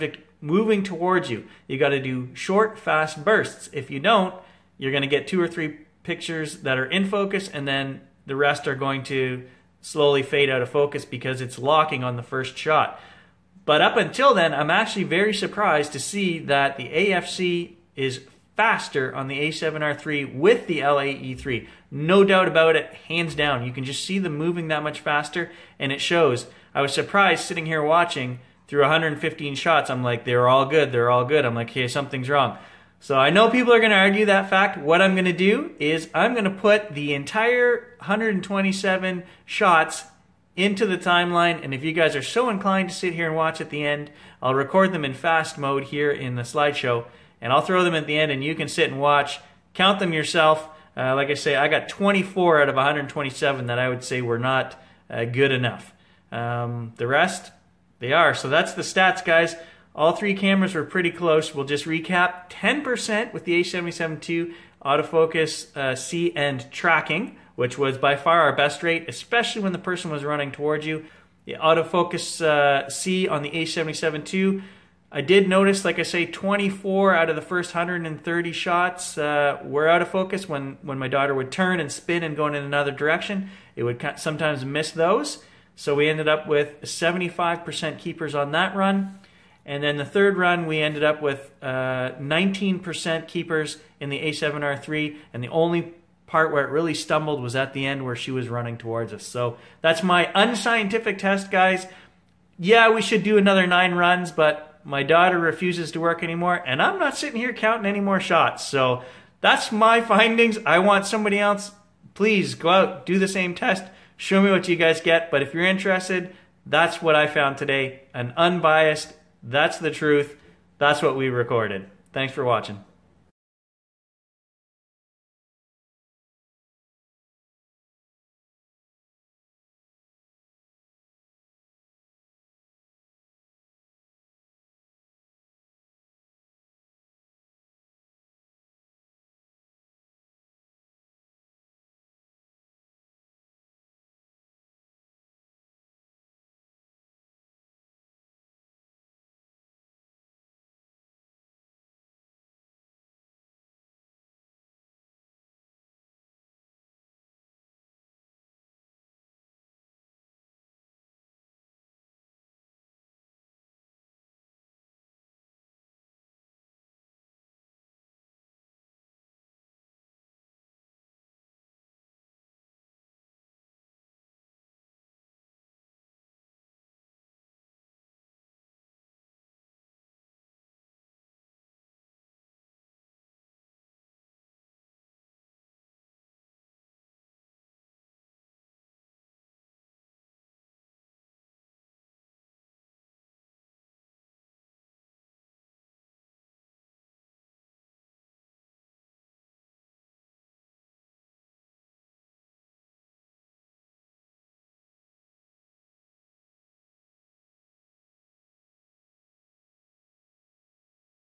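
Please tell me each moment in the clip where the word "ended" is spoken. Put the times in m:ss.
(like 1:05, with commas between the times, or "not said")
1:26, 1:30.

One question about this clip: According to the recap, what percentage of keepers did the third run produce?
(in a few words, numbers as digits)
19%.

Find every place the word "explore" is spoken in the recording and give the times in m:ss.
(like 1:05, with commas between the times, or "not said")
not said.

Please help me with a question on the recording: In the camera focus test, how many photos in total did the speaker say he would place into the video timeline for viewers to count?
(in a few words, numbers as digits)
127.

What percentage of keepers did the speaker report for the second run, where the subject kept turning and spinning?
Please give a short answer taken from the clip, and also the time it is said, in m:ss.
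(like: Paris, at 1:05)
75%, at 1:26.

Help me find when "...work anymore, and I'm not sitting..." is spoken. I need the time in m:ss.
1:46.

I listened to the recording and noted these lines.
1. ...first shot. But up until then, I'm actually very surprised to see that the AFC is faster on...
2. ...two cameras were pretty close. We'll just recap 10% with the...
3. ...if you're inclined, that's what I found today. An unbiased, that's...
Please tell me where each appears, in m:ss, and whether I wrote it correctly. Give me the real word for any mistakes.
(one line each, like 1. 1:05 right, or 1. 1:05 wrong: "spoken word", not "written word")
1. 0:12 right
2. 1:00 wrong: "three", not "two"
3. 1:55 wrong: "interested", not "inclined".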